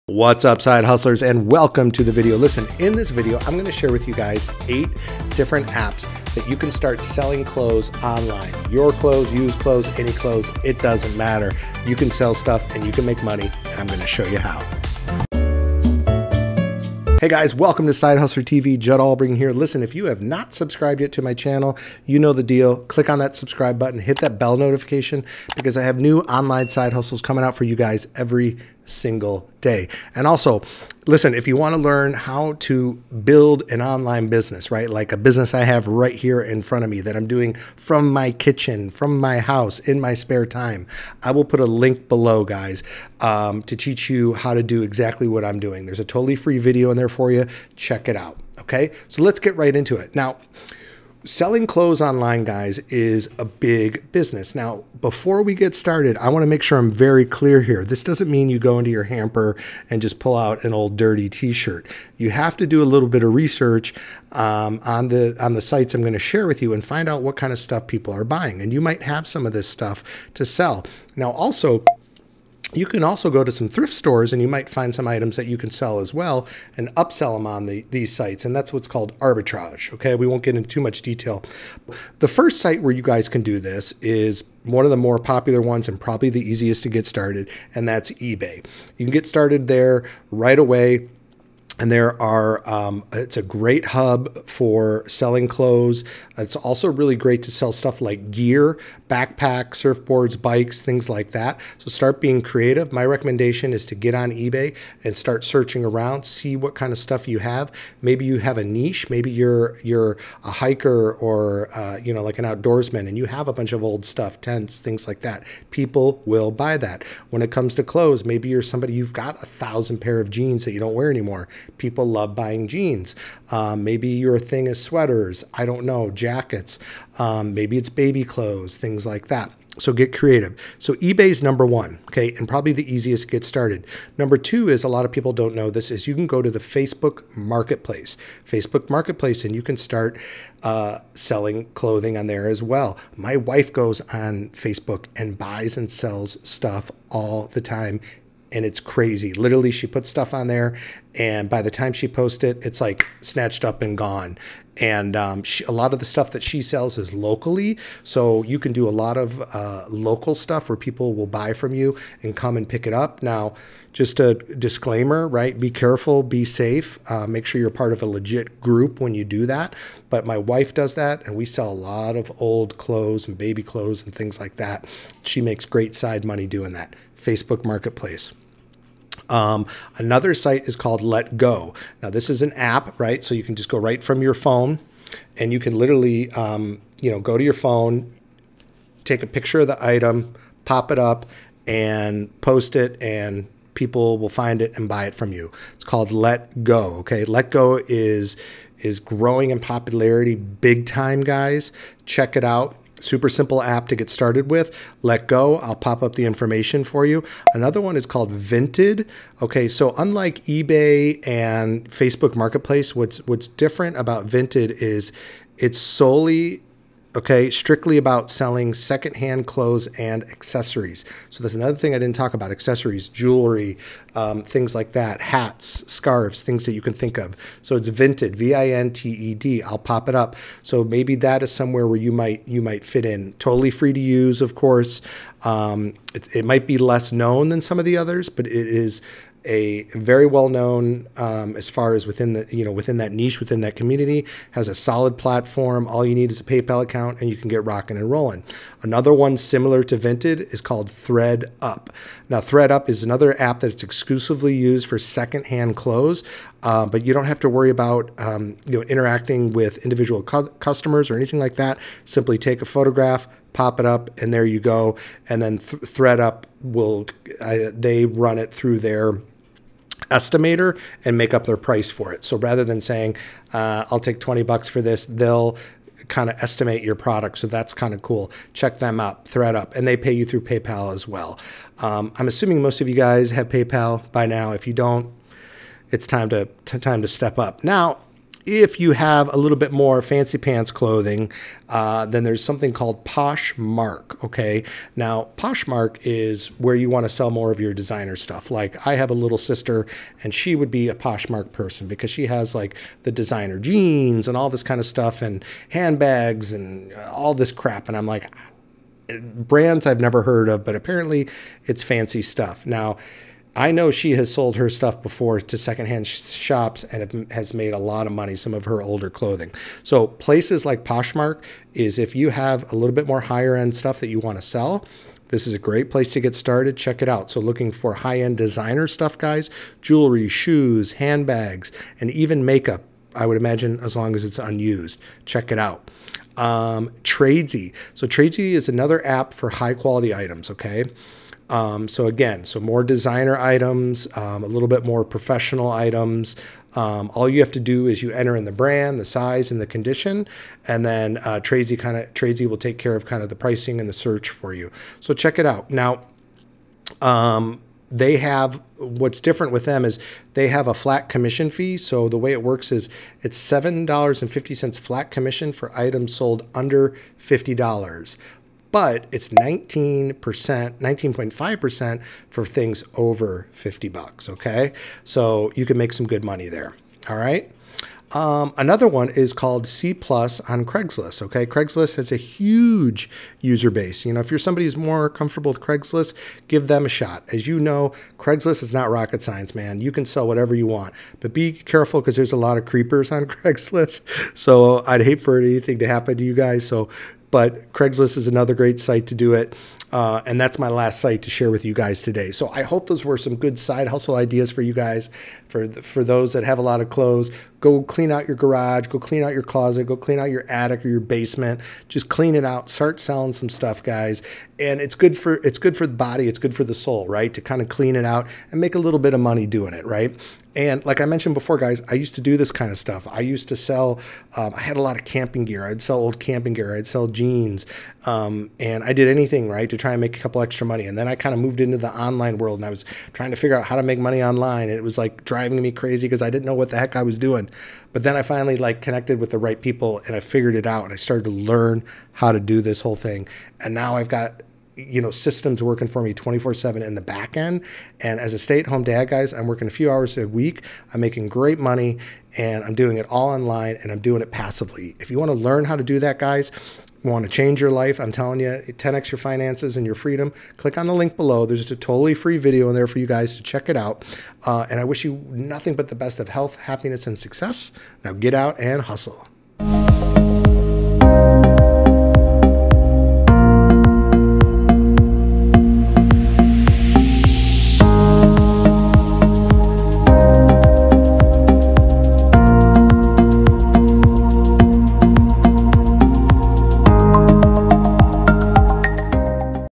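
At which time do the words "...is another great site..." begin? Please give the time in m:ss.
6:38.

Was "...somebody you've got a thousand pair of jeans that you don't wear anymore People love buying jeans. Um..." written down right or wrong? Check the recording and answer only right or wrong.
right.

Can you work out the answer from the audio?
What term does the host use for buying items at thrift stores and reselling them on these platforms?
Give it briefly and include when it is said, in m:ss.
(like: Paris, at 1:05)
arbitrage, at 1:19.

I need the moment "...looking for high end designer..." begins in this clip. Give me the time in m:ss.
5:27.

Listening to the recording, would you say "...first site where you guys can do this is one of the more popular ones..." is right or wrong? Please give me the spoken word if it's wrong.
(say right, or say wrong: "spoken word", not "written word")
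right.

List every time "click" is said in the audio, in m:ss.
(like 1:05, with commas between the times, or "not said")
0:22, 7:40.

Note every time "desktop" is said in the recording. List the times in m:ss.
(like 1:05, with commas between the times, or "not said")
not said.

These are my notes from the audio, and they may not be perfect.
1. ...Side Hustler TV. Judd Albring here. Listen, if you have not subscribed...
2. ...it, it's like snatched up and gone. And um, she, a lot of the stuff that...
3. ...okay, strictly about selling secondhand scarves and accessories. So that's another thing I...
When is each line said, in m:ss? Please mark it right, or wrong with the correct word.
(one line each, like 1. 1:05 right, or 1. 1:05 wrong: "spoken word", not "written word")
1. 0:17 right
2. 2:32 right
3. 3:37 wrong: "clothes", not "scarves".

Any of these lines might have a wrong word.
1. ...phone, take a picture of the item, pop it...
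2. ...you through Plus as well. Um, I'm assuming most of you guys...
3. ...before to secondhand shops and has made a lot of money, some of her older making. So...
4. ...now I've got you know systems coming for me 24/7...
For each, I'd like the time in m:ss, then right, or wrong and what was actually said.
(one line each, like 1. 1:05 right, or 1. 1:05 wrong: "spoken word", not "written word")
1. 3:07 right
2. 4:40 wrong: "PayPal", not "Plus"
3. 5:15 wrong: "clothing", not "making"
4. 7:23 wrong: "working", not "coming".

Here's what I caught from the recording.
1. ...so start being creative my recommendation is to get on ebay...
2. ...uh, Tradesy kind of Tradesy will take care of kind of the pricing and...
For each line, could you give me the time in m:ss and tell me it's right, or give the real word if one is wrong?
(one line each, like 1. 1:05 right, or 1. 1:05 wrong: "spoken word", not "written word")
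1. 1:41 right
2. 5:51 right.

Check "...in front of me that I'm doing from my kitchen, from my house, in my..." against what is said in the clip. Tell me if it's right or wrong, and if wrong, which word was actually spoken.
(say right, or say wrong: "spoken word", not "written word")
right.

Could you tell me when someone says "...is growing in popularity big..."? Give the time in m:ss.
3:18.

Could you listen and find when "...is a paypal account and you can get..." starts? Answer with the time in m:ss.
4:06.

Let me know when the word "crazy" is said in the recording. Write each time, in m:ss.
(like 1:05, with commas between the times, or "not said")
2:28, 7:15.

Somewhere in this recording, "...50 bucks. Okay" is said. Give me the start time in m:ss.
6:13.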